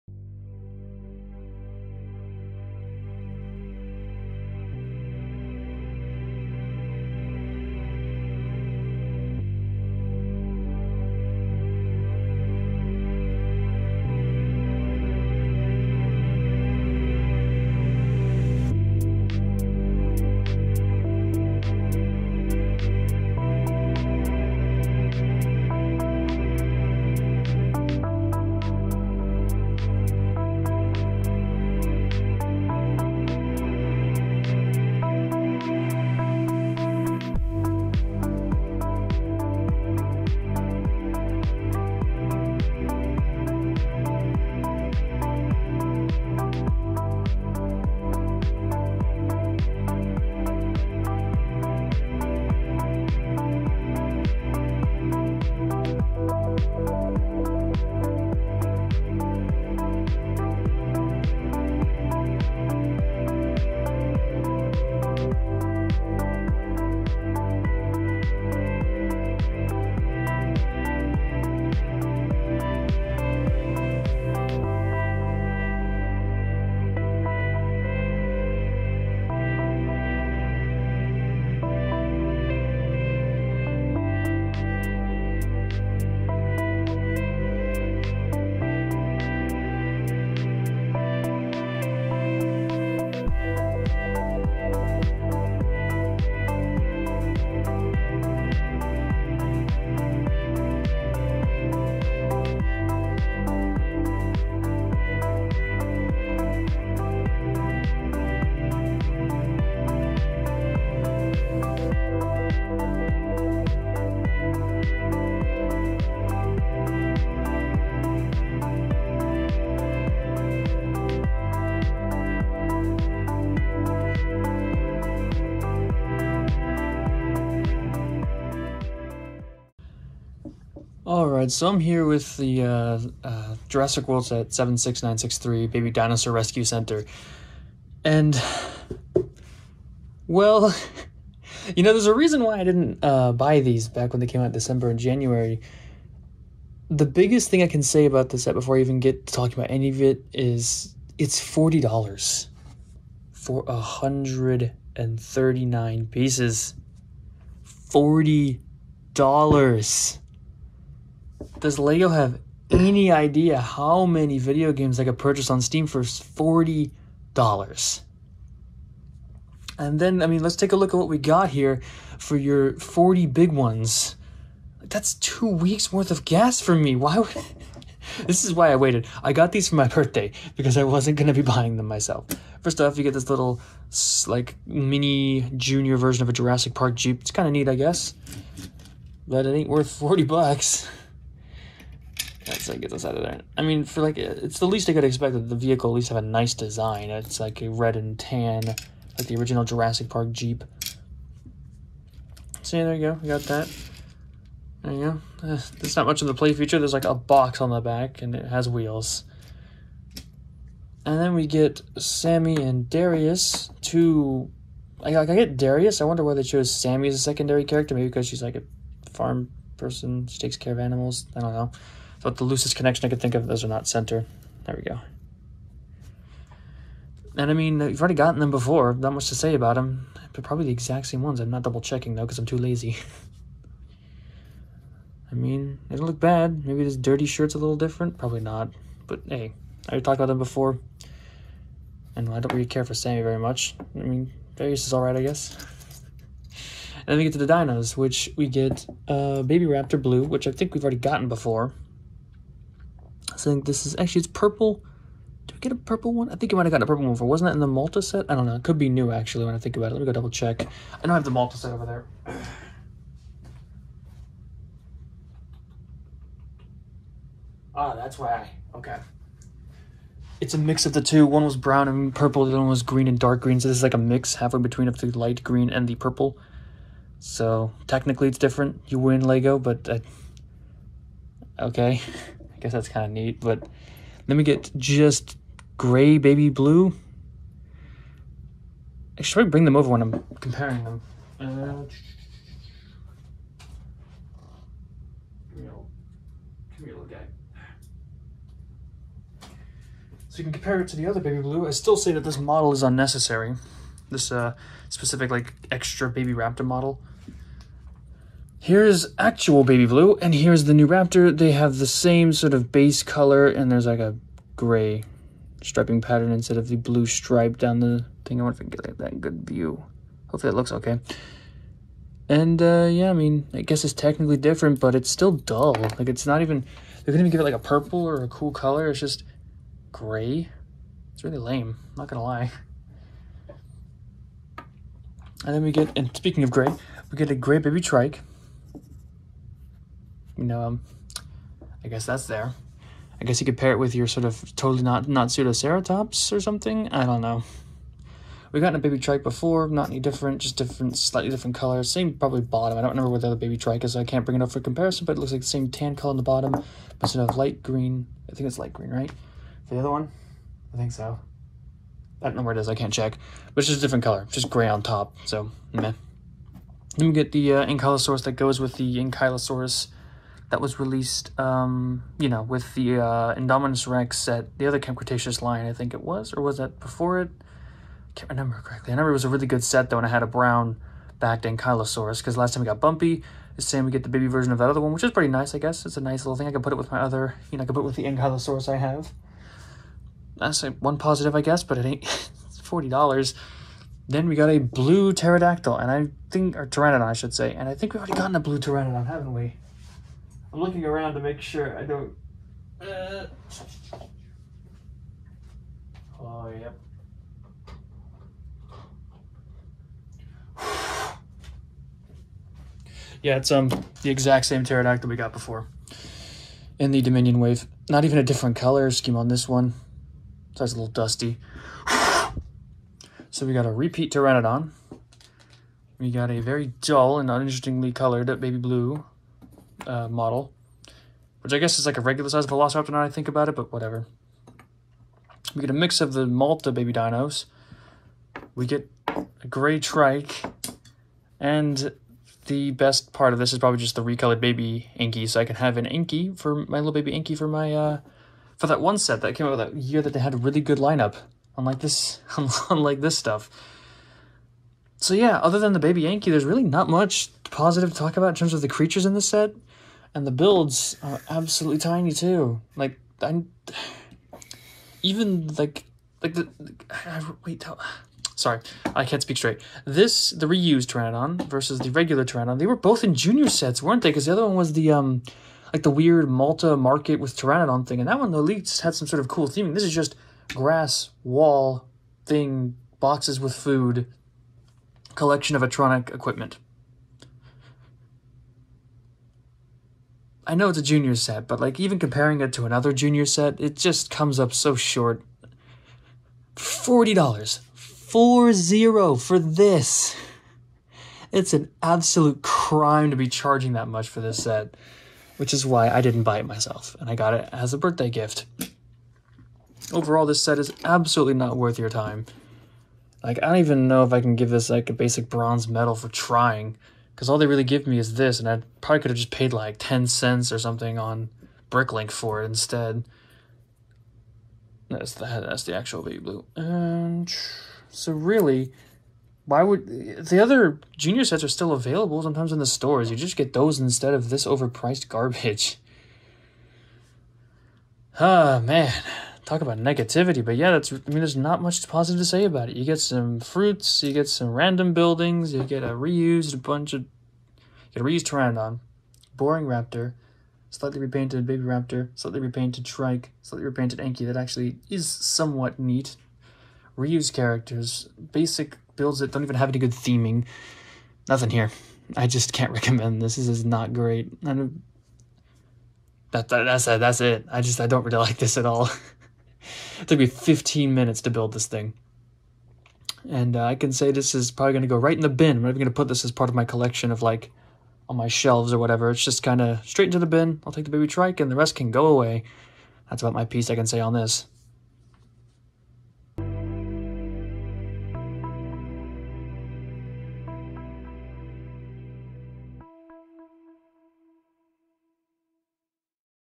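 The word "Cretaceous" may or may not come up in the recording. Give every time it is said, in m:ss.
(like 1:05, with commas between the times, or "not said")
6:14.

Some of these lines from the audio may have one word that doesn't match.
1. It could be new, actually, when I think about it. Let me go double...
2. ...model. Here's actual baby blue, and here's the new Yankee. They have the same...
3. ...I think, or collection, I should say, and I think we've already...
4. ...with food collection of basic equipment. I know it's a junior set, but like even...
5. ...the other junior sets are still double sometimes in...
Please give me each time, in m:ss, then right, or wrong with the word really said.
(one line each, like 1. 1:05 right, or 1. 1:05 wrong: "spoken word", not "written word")
1. 4:18 right
2. 5:06 wrong: "Raptor", not "Yankee"
3. 6:35 wrong: "pteranodon", not "collection"
4. 8:03 wrong: "electronic", not "basic"
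5. 8:50 wrong: "available", not "double".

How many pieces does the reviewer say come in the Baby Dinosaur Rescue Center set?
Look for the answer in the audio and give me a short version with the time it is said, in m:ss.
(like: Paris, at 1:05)
139, at 2:33.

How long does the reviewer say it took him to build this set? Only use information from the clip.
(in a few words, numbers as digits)
15 minutes.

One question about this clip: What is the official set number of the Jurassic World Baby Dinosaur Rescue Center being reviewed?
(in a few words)
76963.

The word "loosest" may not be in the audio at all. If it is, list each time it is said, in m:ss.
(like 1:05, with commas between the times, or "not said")
3:42.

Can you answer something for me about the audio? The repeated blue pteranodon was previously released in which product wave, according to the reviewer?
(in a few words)
Dominion wave.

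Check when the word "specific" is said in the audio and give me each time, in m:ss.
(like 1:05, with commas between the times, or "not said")
5:04.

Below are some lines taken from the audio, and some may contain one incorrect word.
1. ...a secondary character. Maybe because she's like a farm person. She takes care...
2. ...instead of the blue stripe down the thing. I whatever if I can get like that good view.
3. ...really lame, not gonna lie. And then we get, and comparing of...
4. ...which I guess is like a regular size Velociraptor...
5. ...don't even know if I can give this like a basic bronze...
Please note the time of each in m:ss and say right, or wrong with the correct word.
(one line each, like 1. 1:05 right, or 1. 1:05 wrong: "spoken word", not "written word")
1. 3:37 right
2. 5:16 wrong: "wonder", not "whatever"
3. 5:31 wrong: "speaking", not "comparing"
4. 7:11 right
5. 8:33 right.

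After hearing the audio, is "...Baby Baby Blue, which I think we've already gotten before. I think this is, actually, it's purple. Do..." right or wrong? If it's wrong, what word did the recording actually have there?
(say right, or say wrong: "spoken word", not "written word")
wrong: "Raptor", not "Baby".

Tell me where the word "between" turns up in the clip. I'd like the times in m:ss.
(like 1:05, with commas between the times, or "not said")
4:34.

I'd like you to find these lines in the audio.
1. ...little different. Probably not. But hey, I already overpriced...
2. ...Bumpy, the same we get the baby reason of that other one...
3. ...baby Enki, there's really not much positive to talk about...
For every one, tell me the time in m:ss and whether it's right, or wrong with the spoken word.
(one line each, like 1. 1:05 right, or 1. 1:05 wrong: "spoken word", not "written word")
1. 3:57 wrong: "talked", not "overpriced"
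2. 6:22 wrong: "version", not "reason"
3. 7:35 wrong: "Yankee", not "Enki".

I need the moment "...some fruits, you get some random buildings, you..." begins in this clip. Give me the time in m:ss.
9:03.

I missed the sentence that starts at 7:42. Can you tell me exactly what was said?
Like I, even like like the, I, wait how, sorry I can't speak straight.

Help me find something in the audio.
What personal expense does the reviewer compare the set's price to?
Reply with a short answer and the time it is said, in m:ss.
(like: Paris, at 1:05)
two weeks worth of gas, at 2:55.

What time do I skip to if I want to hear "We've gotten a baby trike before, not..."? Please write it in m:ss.
5:48.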